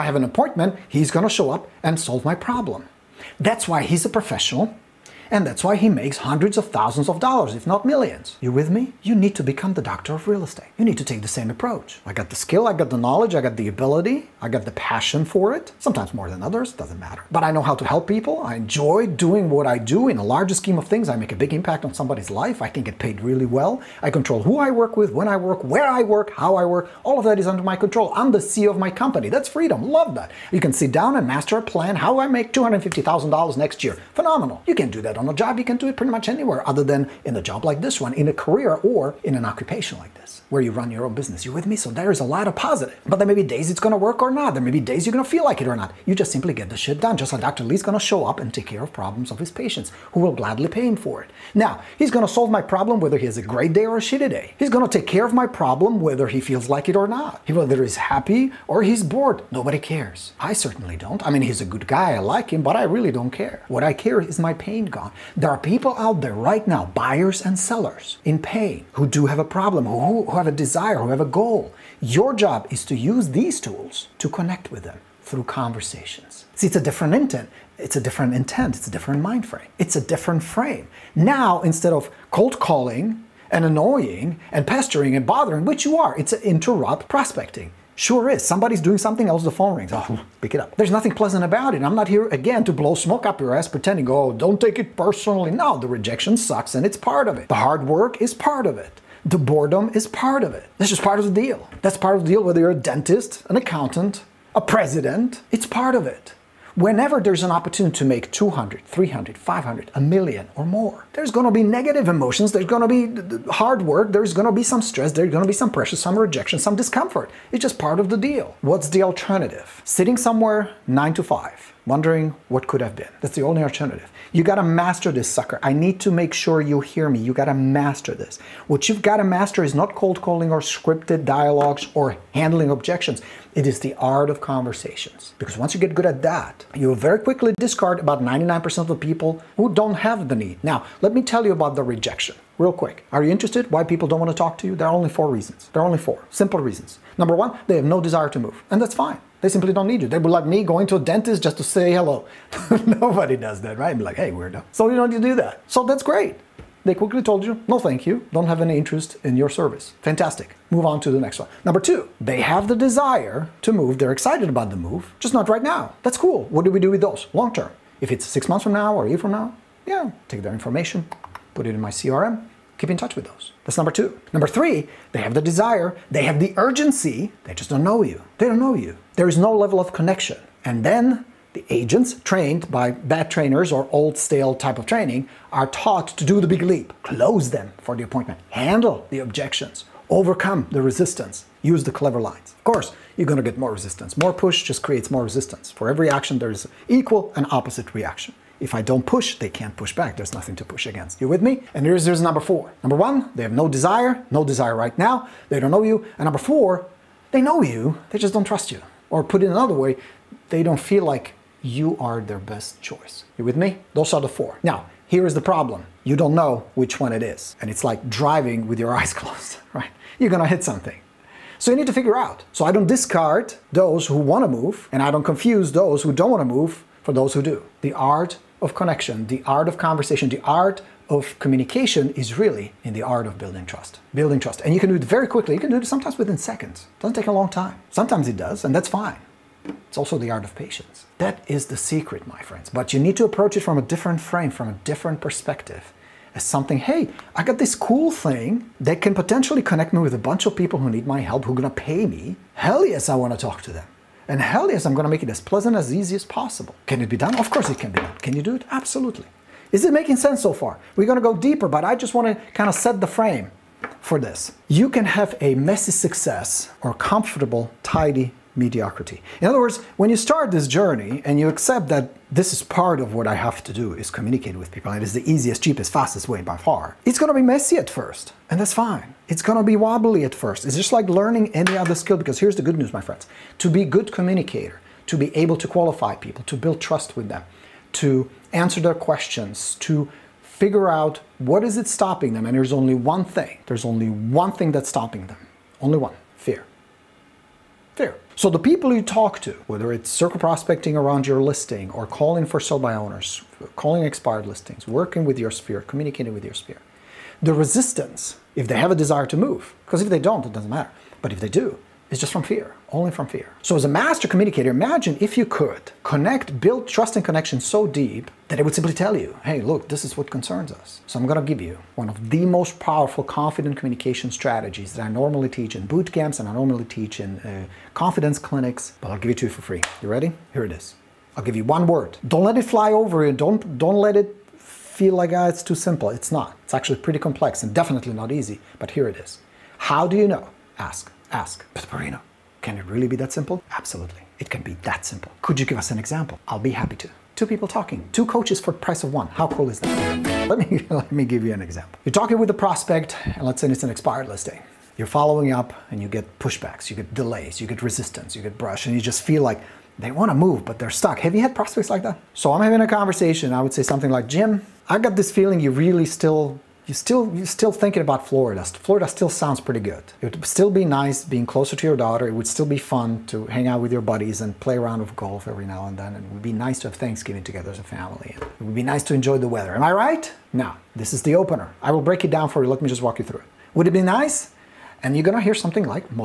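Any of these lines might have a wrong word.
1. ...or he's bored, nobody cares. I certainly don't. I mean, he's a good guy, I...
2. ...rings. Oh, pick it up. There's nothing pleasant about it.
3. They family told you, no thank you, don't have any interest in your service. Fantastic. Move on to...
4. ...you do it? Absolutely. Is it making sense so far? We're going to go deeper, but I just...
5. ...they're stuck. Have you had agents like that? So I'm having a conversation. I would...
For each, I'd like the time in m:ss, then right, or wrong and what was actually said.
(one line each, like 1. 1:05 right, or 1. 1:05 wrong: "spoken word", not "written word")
1. 0:58 right
2. 1:29 right
3. 2:36 wrong: "quickly", not "family"
4. 4:18 right
5. 6:00 wrong: "prospects", not "agents".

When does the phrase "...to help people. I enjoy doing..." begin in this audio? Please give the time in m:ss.
0:17.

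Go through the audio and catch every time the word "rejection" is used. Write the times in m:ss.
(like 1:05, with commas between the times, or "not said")
1:35, 1:56, 2:21.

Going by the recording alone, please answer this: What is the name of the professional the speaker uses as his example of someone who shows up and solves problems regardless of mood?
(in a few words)
Dr. Lee.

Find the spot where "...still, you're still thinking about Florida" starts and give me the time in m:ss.
6:06.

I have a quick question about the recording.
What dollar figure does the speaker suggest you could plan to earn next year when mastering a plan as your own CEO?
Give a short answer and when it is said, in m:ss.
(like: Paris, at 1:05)
$250,000, at 0:32.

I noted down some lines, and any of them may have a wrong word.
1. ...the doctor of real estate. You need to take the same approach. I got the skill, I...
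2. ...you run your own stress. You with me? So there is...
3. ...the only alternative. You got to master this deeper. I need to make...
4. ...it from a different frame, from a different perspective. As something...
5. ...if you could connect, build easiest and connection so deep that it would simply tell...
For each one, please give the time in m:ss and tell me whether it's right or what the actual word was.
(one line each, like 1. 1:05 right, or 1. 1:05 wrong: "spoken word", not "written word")
1. 0:09 right
2. 0:40 wrong: "business", not "stress"
3. 2:03 wrong: "sucker", not "deeper"
4. 4:03 right
5. 5:15 wrong: "trust", not "easiest".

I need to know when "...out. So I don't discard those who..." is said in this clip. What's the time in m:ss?
3:42.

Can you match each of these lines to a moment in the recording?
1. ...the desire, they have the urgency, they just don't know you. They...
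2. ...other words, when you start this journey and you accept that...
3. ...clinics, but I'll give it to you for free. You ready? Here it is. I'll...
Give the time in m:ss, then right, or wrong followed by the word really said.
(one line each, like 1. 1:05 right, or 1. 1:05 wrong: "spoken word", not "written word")
1. 2:55 right
2. 4:29 right
3. 5:28 right.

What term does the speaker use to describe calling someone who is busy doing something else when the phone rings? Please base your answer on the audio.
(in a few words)
interrupt prospecting.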